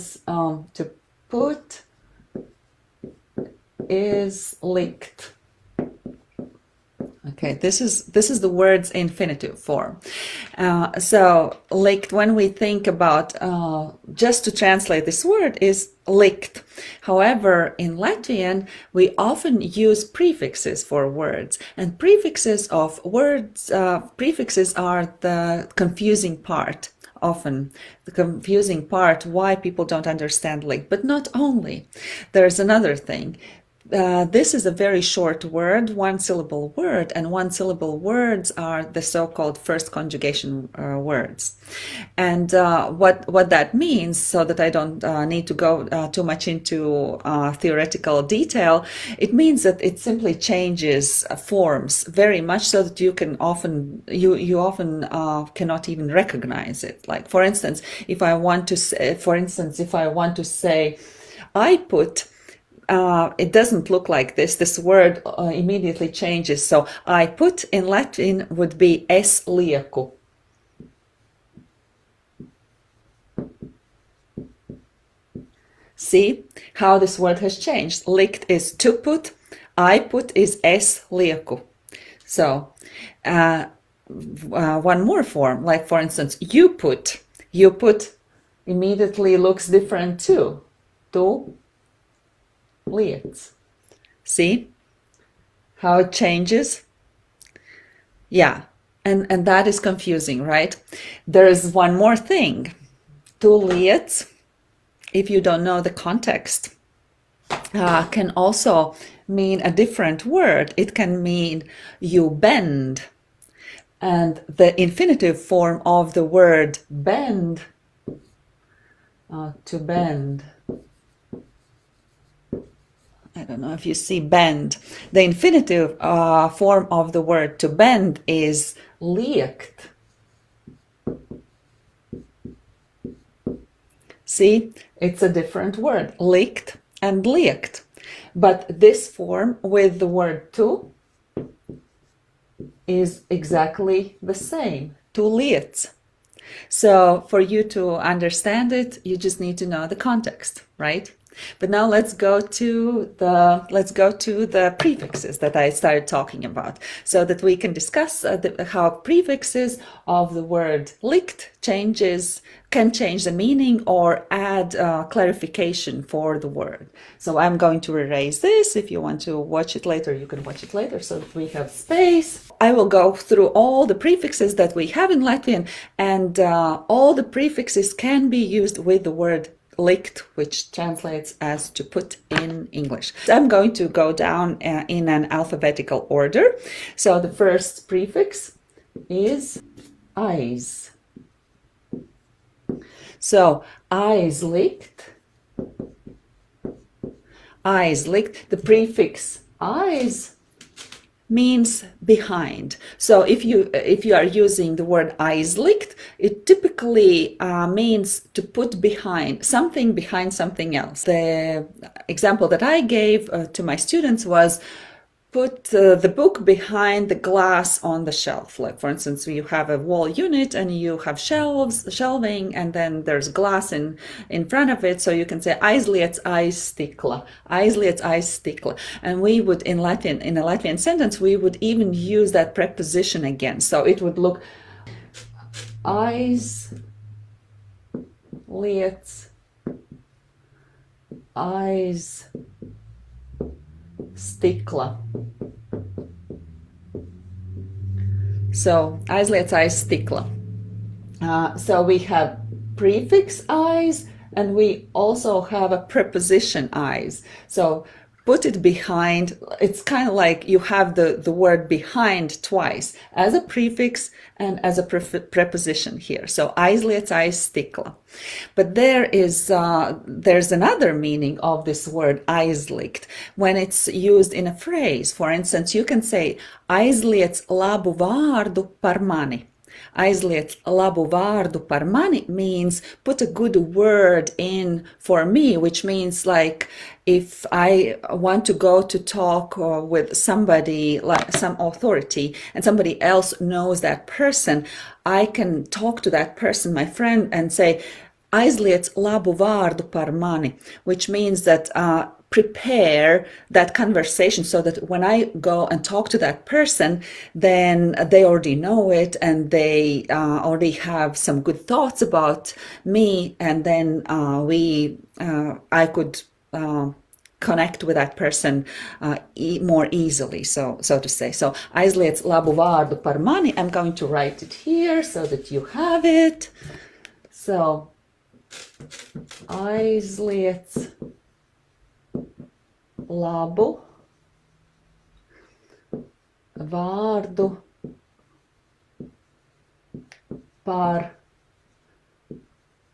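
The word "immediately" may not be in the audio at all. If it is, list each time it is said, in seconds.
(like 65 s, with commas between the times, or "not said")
65 s, 88 s.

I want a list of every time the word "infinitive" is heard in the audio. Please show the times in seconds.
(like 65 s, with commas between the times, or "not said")
8 s, 114 s, 125 s.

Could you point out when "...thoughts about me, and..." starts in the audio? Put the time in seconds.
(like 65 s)
311 s.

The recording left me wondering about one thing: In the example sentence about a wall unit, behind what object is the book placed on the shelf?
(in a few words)
the glass.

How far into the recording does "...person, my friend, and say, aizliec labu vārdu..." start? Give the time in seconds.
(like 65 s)
296 s.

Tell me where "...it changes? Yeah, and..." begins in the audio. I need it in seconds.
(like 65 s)
95 s.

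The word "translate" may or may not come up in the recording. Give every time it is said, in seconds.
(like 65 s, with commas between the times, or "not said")
14 s, 180 s.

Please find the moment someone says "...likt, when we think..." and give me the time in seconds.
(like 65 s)
11 s.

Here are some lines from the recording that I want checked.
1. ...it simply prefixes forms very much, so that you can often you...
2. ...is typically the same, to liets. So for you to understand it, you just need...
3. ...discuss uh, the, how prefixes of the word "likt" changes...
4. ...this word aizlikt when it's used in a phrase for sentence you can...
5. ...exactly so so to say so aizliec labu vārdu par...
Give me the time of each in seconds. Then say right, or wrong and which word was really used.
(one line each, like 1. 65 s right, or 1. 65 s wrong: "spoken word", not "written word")
1. 49 s wrong: "changes", not "prefixes"
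2. 142 s wrong: "exactly", not "typically"
3. 157 s right
4. 271 s wrong: "instance", not "sentence"
5. 319 s wrong: "easily", not "exactly".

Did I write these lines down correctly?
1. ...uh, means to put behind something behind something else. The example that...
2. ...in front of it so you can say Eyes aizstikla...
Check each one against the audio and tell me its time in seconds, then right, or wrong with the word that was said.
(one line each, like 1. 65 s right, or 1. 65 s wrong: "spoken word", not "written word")
1. 207 s right
2. 224 s right.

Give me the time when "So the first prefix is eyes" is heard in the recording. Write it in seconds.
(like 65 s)
186 s.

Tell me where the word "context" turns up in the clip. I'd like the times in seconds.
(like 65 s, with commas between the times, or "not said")
105 s, 149 s.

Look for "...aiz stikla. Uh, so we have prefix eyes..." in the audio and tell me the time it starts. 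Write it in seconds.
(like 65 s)
249 s.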